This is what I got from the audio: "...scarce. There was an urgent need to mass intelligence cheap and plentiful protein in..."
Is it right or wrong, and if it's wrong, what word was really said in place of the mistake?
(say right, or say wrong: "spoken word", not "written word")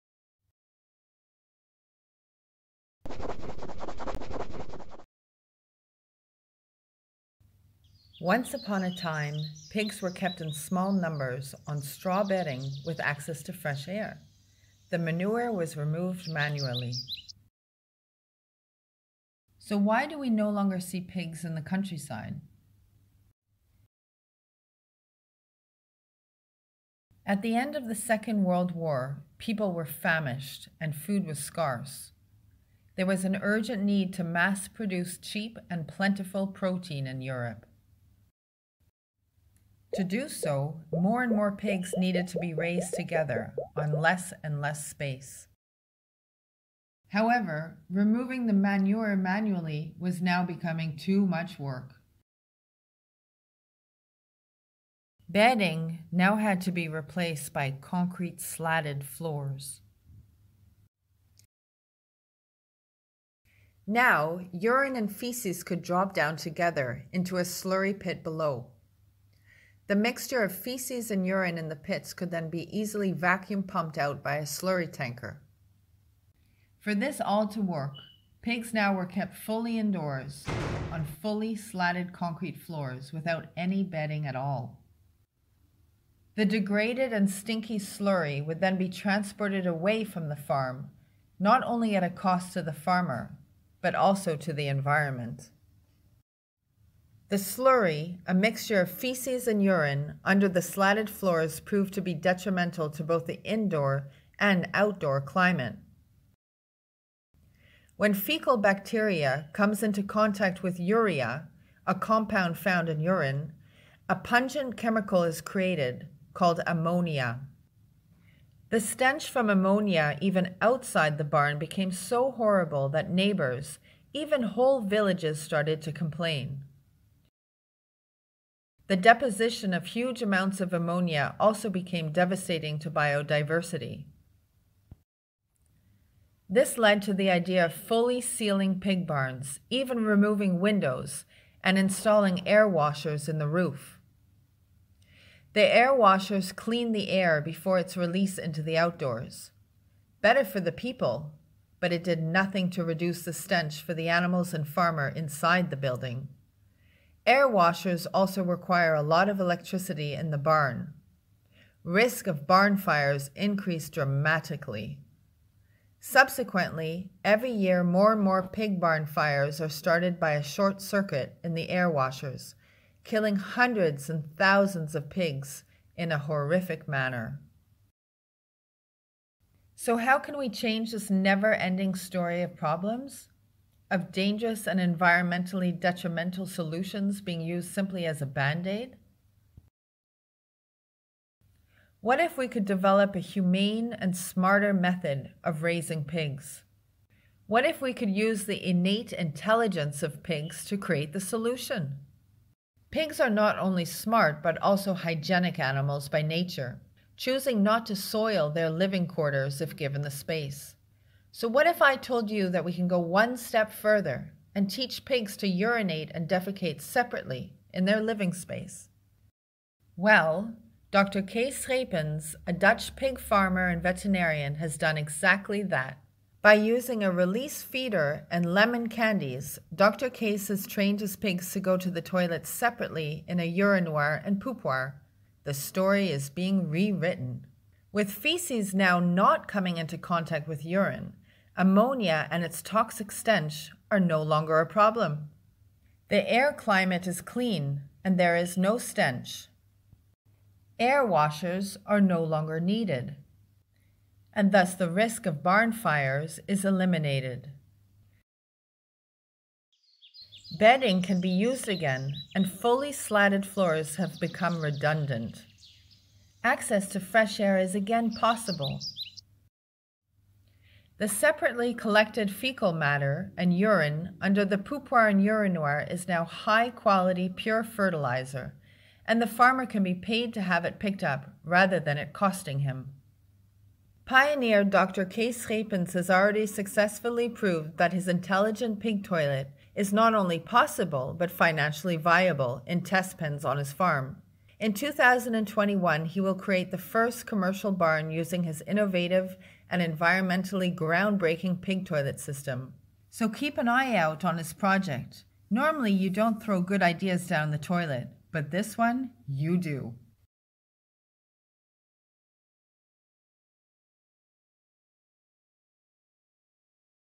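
wrong: "produce", not "intelligence".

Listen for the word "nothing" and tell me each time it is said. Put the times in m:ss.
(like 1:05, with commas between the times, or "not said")
2:32.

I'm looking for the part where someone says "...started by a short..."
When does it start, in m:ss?
2:49.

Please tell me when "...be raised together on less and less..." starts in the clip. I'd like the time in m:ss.
0:42.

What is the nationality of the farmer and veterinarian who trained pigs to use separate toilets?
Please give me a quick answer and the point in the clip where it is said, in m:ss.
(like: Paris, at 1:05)
Dutch, at 3:42.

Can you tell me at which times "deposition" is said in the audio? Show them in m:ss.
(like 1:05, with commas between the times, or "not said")
2:08.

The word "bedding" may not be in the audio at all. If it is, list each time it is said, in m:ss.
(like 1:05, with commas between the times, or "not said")
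0:12, 0:55, 1:23, 4:20.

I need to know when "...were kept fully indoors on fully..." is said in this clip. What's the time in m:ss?
1:18.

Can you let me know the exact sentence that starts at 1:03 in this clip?
Now, urine and feces could drop down together into a slurry pit below.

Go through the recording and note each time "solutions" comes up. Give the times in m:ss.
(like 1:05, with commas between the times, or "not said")
3:06, 3:21.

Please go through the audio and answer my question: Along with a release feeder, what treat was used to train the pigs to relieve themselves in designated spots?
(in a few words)
lemon candies.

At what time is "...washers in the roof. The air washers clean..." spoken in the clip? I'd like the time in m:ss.
2:22.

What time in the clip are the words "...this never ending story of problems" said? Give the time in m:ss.
3:00.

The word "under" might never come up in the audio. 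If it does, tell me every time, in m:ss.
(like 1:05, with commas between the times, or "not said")
1:40, 4:34.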